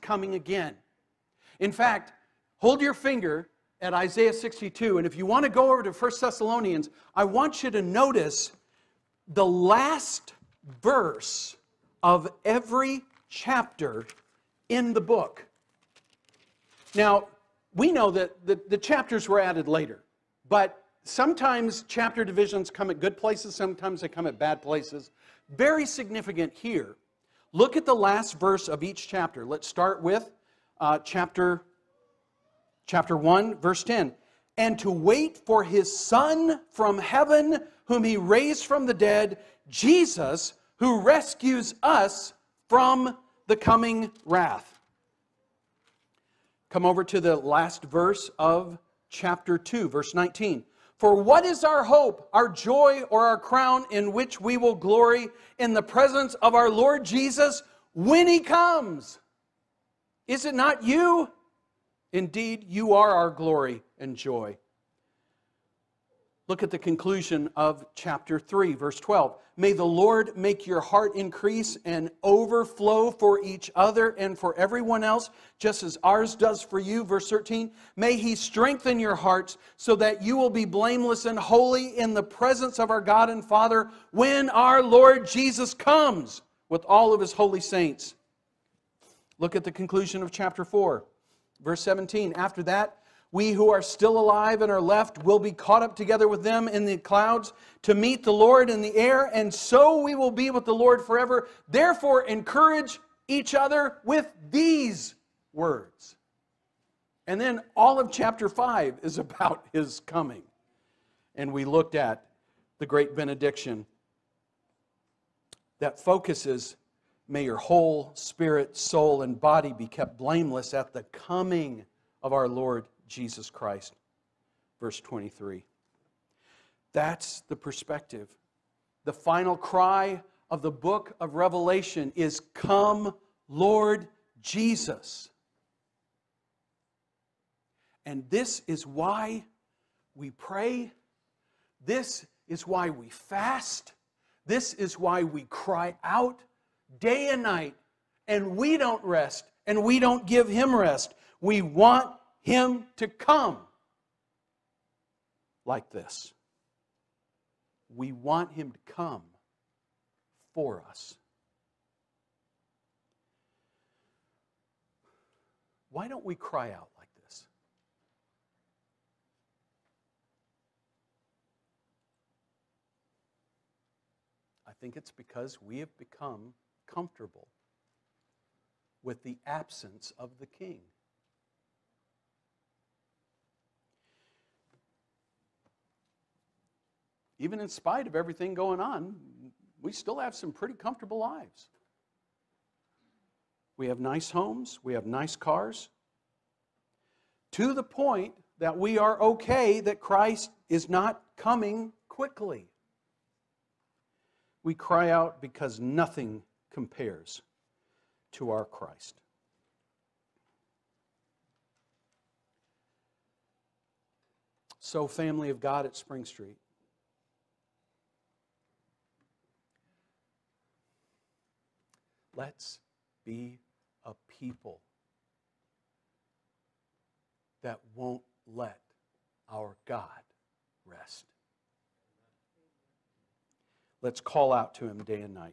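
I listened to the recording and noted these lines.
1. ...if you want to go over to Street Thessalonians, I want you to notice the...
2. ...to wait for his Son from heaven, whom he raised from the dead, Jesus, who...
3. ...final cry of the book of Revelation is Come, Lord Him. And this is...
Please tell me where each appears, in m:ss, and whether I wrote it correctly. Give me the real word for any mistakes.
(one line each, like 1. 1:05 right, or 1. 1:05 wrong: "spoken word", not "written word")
1. 0:05 wrong: "First", not "Street"
2. 0:34 right
3. 2:09 wrong: "Jesus", not "Him".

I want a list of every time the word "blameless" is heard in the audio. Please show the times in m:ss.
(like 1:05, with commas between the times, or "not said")
1:20, 2:00.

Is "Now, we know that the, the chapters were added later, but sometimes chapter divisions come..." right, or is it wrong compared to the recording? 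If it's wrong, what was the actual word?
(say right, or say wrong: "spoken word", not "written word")
right.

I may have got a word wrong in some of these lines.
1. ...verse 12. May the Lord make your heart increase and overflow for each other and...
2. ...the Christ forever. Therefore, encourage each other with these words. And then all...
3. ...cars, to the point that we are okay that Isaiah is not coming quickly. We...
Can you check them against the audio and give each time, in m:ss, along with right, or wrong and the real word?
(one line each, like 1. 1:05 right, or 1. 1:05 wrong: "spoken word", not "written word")
1. 1:08 right
2. 1:40 wrong: "Lord", not "Christ"
3. 3:15 wrong: "Christ", not "Isaiah".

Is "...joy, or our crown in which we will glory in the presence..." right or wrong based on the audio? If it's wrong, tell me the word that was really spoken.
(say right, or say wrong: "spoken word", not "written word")
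right.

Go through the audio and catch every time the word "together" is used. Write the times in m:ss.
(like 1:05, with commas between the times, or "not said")
1:35.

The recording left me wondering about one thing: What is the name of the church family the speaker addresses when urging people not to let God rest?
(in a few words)
Spring Street.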